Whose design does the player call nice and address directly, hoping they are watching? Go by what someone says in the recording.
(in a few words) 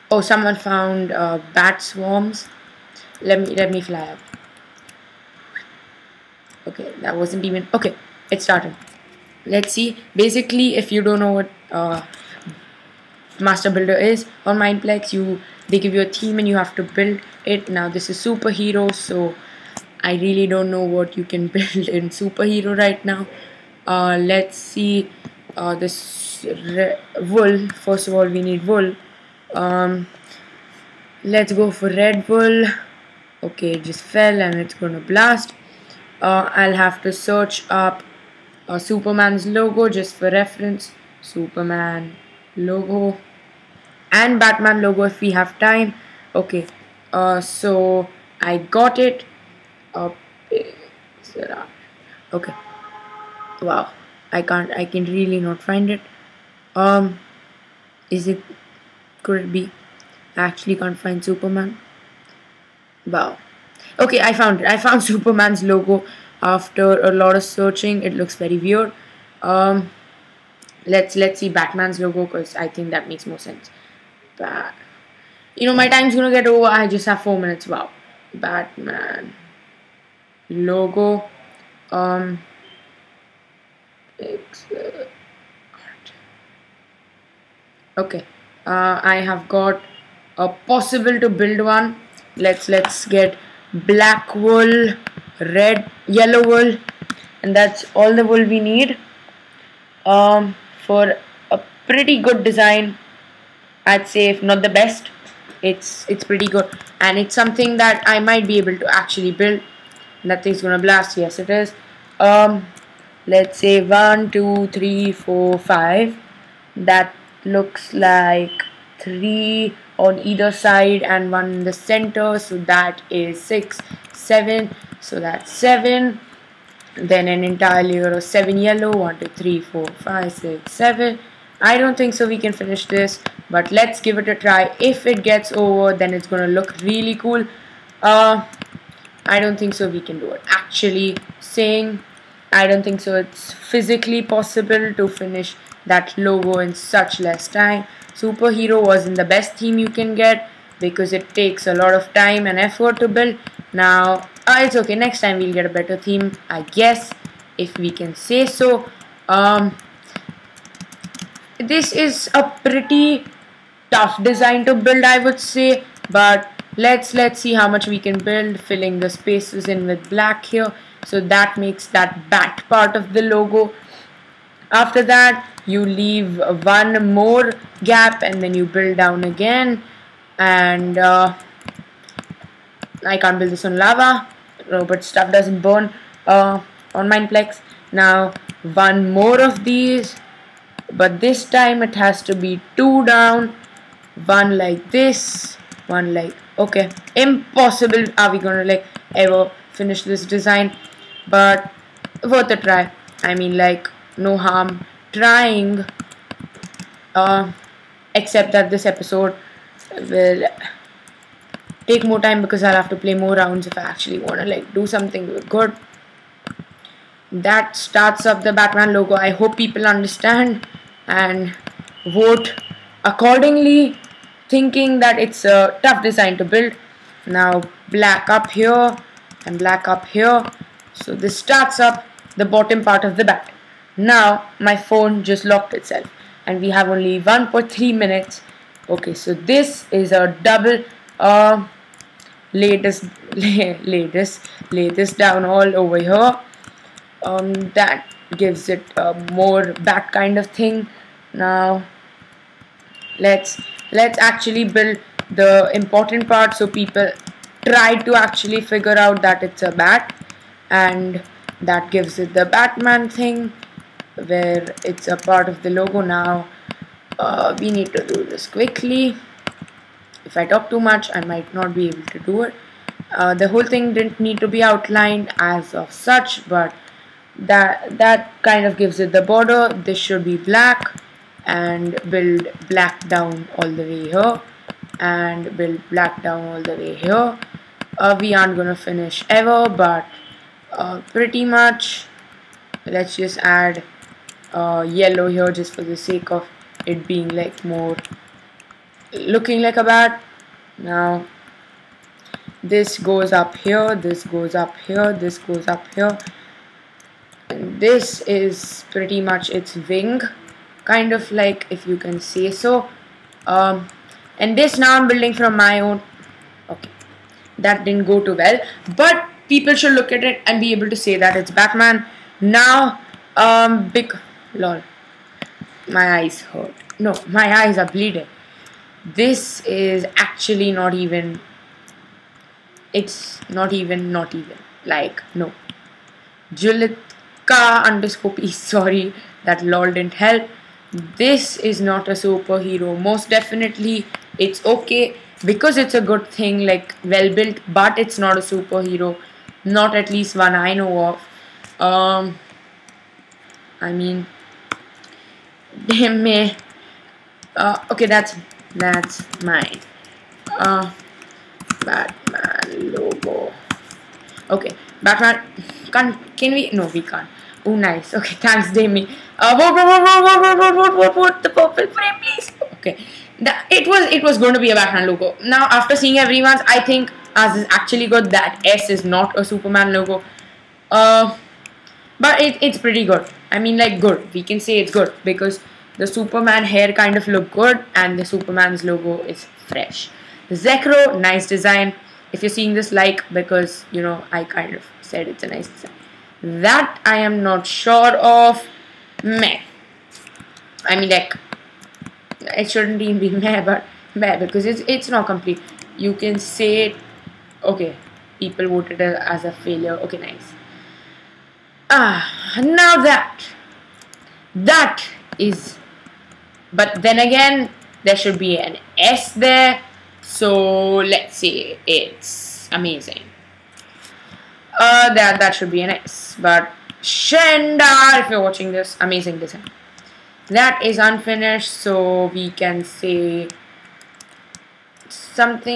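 Zekro.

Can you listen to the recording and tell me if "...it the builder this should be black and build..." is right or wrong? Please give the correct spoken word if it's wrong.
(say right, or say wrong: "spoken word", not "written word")
wrong: "border", not "builder".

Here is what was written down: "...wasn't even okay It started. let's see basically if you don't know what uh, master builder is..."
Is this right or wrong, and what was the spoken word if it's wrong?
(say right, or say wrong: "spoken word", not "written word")
right.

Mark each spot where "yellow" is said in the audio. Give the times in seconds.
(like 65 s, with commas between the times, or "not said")
96 s, 128 s, 294 s.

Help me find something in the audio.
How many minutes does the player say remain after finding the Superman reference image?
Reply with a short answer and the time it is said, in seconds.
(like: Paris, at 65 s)
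4, at 77 s.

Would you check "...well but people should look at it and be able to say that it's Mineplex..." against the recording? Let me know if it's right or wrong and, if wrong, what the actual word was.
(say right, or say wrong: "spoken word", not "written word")
wrong: "Batman", not "Mineplex".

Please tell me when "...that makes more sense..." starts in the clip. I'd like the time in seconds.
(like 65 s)
72 s.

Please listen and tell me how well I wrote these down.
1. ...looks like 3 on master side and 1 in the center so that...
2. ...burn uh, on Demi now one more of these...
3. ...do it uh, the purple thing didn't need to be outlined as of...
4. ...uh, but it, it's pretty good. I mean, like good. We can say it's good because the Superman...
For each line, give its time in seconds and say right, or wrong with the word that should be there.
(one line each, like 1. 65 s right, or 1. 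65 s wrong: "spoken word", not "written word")
1. 117 s wrong: "either", not "master"
2. 185 s wrong: "Mineplex", not "Demi"
3. 272 s wrong: "whole", not "purple"
4. 380 s right.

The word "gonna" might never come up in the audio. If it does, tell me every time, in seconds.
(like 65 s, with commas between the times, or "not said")
34 s, 76 s, 110 s, 136 s, 198 s, 288 s.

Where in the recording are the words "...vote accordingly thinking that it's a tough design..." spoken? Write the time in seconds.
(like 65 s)
222 s.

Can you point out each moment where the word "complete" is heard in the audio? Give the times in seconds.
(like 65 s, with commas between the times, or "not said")
405 s.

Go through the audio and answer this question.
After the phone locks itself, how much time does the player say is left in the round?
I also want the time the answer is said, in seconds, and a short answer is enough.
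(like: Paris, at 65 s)
1.3 minutes, at 237 s.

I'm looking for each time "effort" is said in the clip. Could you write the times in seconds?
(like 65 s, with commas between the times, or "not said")
152 s.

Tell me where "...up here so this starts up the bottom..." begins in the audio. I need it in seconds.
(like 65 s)
229 s.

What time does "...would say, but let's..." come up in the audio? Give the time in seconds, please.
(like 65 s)
165 s.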